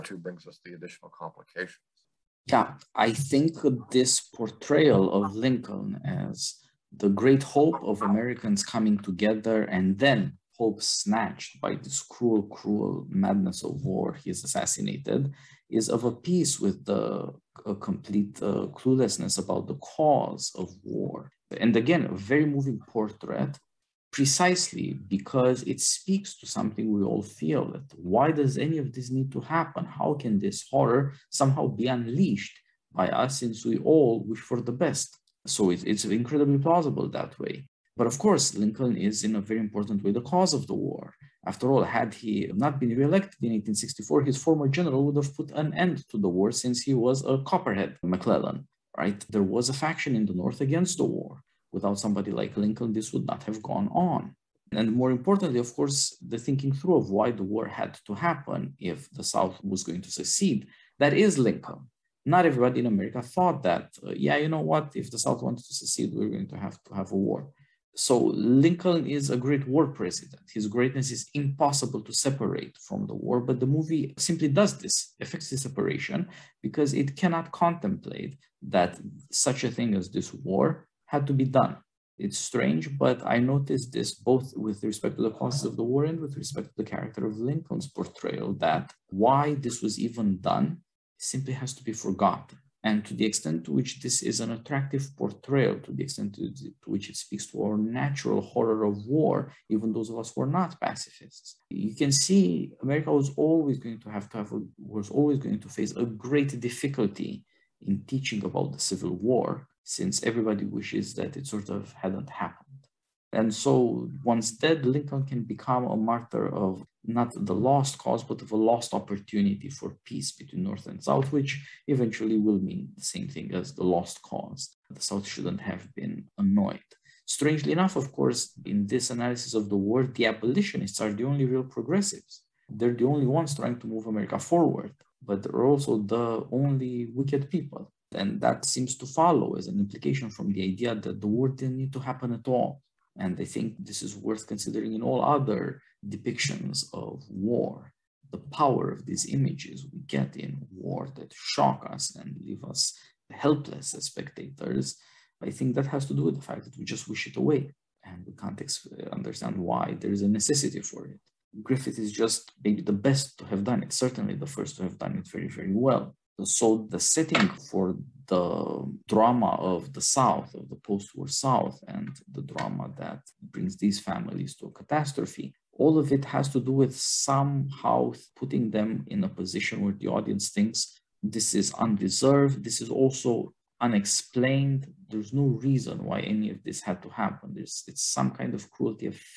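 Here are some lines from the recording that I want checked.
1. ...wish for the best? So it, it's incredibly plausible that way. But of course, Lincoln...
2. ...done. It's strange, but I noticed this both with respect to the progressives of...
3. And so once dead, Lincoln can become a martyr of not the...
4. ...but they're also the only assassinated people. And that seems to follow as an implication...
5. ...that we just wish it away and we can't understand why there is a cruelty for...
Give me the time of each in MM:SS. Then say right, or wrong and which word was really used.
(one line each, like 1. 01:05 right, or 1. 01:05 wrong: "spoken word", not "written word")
1. 00:34 right
2. 01:21 wrong: "causes", not "progressives"
3. 01:53 right
4. 02:15 wrong: "wicked", not "assassinated"
5. 02:36 wrong: "necessity", not "cruelty".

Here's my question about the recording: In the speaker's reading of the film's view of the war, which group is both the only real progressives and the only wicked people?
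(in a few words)
the abolitionists.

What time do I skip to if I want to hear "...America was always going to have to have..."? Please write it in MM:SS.
01:42.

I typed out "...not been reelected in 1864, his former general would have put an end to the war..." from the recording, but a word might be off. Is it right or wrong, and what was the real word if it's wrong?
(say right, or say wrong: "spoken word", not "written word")
right.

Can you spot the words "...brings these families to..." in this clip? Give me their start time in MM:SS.
02:53.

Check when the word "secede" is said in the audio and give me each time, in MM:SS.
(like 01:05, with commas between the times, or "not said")
01:00, 01:05.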